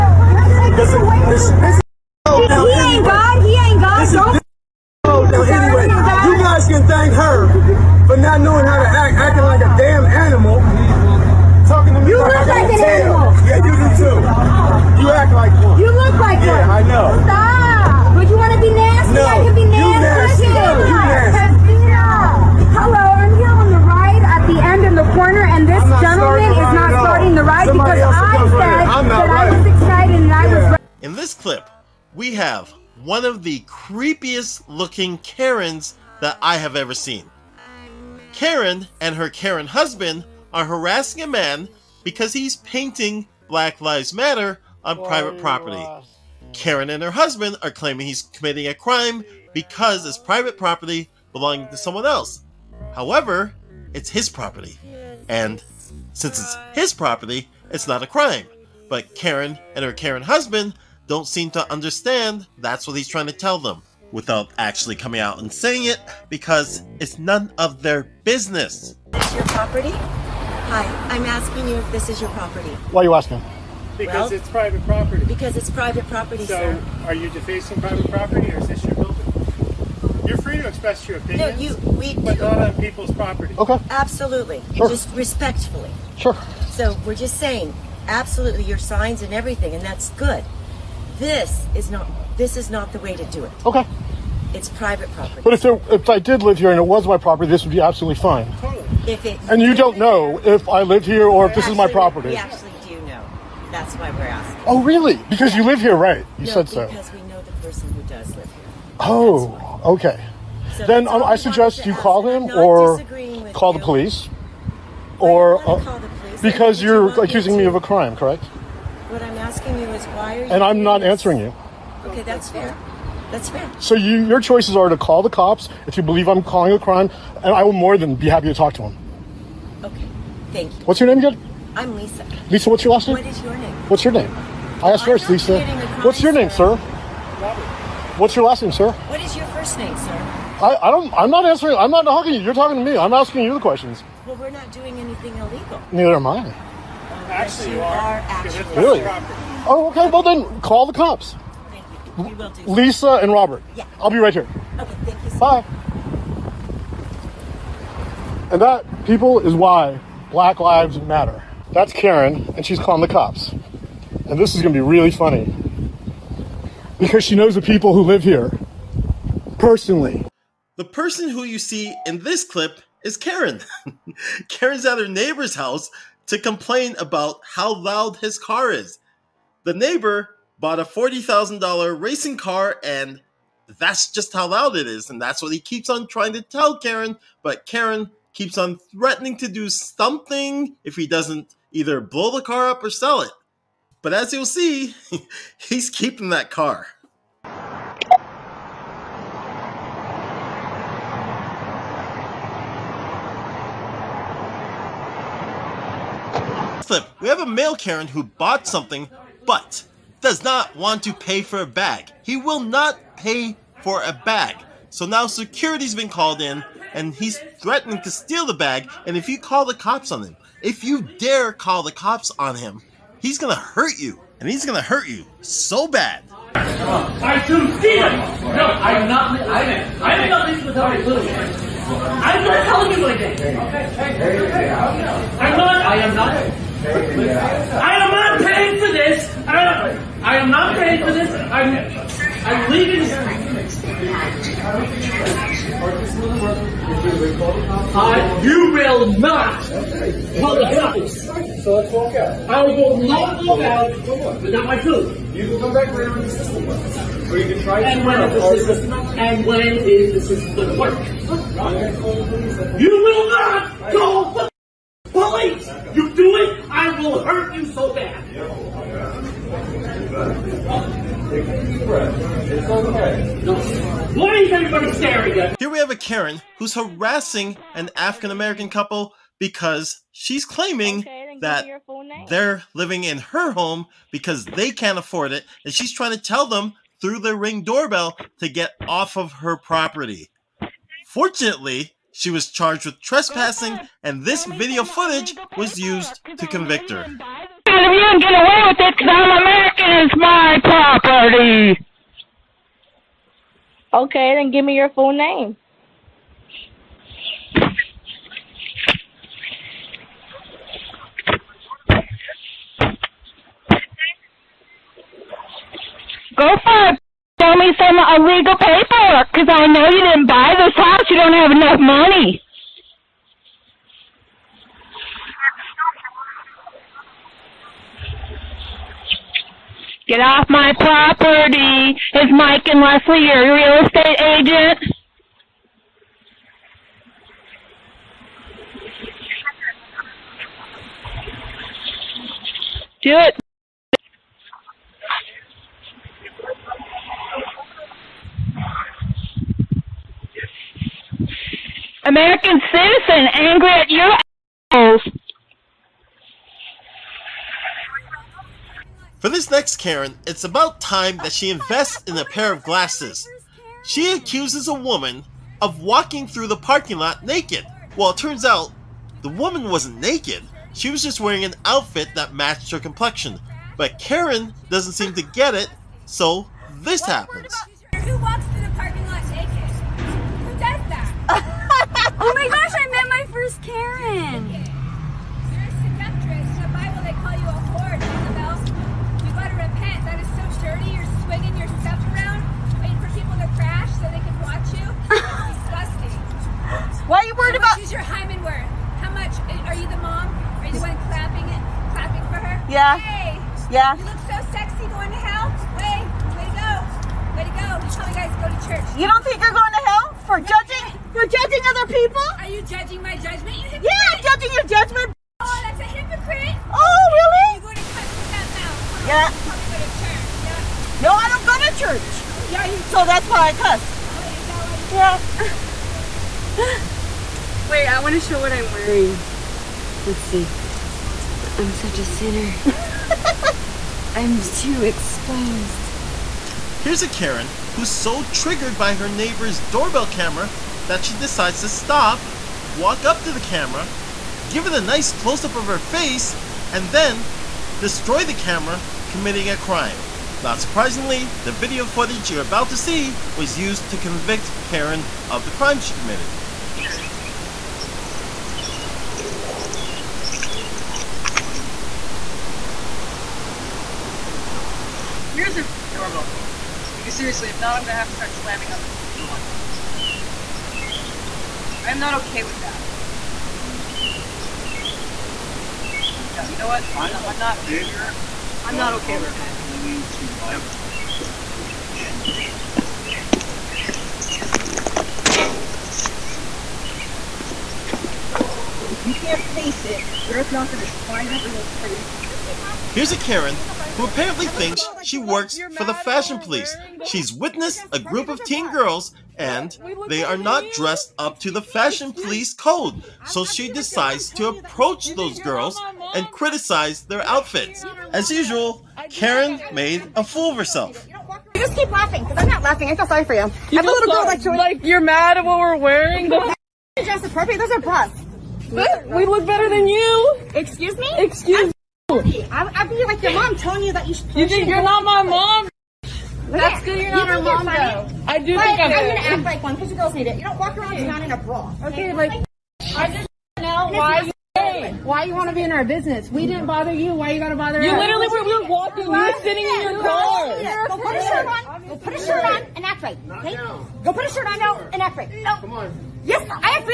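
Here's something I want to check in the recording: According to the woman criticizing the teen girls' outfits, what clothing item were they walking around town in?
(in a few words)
A bra.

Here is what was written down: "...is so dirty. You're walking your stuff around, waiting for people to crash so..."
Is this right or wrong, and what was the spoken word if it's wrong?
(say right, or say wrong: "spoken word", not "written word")
wrong: "swinging", not "walking".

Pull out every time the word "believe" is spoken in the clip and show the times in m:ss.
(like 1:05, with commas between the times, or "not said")
2:06.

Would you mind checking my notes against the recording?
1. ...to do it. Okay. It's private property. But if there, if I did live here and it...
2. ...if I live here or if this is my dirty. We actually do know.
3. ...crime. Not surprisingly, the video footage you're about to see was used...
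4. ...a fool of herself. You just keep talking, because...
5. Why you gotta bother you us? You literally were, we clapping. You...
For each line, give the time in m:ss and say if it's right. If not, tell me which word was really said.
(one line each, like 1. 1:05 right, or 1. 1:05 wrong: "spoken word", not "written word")
1. 1:33 right
2. 1:40 wrong: "property", not "dirty"
3. 7:29 right
4. 8:30 wrong: "laughing", not "talking"
5. 8:57 wrong: "walking", not "clapping".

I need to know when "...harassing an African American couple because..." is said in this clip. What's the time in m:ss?
4:36.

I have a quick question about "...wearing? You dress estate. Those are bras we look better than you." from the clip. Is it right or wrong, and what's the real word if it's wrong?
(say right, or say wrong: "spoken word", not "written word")
wrong: "appropriate", not "estate".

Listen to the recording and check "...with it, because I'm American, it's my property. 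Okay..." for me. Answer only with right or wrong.
right.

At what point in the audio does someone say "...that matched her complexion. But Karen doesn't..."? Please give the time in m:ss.
6:12.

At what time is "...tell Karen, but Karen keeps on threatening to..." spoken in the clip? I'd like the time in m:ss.
3:06.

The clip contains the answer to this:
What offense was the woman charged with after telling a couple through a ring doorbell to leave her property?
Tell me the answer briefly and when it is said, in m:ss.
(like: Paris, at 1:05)
Trespassing, at 4:52.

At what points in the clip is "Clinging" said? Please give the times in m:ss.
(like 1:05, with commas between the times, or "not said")
7:59.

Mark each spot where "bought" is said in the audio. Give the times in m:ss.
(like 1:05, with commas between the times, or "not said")
3:00, 3:28.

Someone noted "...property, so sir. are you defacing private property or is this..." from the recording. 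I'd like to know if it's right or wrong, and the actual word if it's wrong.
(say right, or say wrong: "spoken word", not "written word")
right.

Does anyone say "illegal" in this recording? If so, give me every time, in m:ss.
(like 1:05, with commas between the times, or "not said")
2:25, 5:17.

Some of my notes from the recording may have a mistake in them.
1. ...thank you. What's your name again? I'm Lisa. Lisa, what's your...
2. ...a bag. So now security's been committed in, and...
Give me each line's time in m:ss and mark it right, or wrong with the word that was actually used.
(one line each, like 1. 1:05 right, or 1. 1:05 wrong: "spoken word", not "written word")
1. 2:10 right
2. 3:34 wrong: "called", not "committed".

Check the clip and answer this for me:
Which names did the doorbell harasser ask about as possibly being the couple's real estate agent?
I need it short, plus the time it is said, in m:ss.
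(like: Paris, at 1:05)
Mike and Leslie, at 5:32.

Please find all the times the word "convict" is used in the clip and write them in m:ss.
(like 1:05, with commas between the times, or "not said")
4:56, 7:33.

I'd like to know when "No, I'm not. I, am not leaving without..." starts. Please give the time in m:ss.
3:48.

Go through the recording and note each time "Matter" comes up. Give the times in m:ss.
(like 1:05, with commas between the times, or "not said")
0:44, 2:41.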